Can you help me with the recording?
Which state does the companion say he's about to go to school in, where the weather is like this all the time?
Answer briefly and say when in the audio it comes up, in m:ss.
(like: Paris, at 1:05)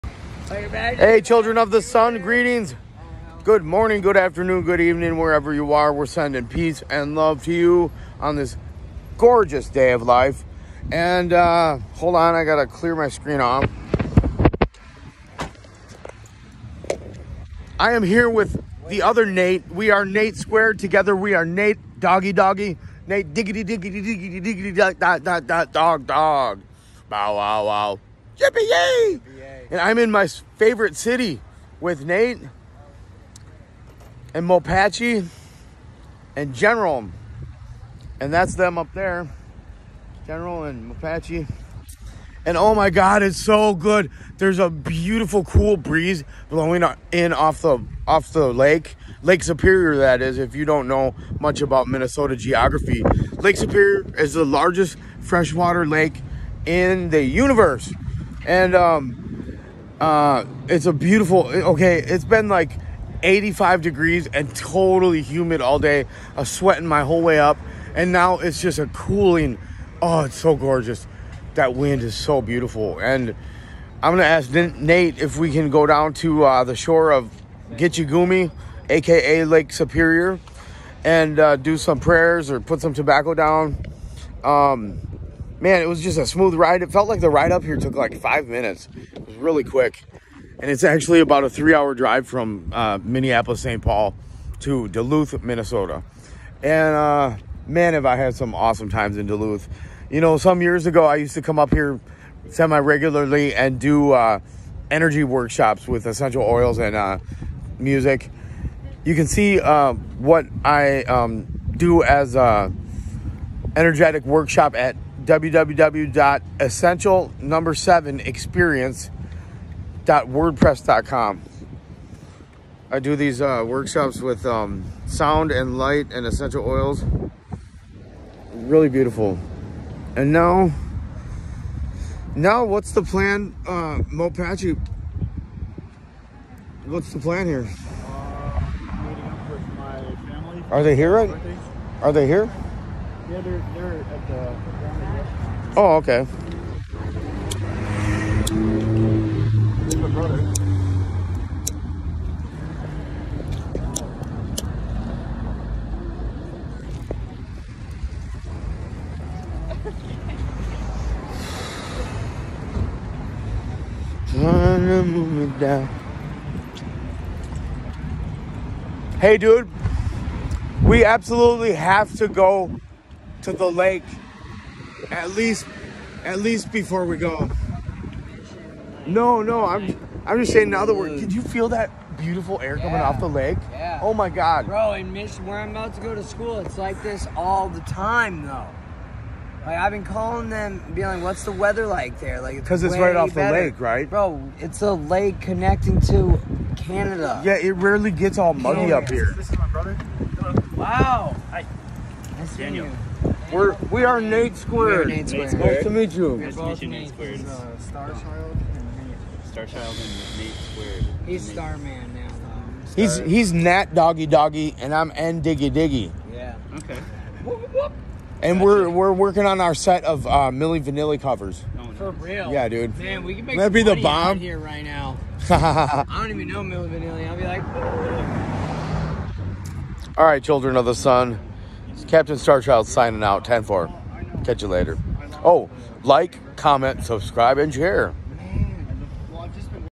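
Michigan, at 3:05.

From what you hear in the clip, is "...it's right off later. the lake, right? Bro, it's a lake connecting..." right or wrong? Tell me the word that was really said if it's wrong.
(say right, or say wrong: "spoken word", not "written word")
wrong: "better", not "later".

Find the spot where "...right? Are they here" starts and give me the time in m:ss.
2:21.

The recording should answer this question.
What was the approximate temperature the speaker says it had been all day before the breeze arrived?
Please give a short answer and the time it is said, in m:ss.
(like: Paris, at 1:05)
85 degrees, at 1:03.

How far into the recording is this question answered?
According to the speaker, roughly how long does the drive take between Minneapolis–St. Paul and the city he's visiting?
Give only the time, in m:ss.
1:31.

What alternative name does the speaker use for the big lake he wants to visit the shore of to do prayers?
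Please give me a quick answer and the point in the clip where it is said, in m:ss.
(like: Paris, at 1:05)
Gitchigumi, at 1:17.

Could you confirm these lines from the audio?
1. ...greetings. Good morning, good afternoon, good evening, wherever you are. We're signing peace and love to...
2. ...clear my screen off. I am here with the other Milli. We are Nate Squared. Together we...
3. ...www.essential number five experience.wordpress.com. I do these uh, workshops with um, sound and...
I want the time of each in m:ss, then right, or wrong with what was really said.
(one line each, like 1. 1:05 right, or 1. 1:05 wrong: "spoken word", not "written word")
1. 0:02 wrong: "sending", not "signing"
2. 0:12 wrong: "Nate", not "Milli"
3. 1:55 wrong: "seven", not "five".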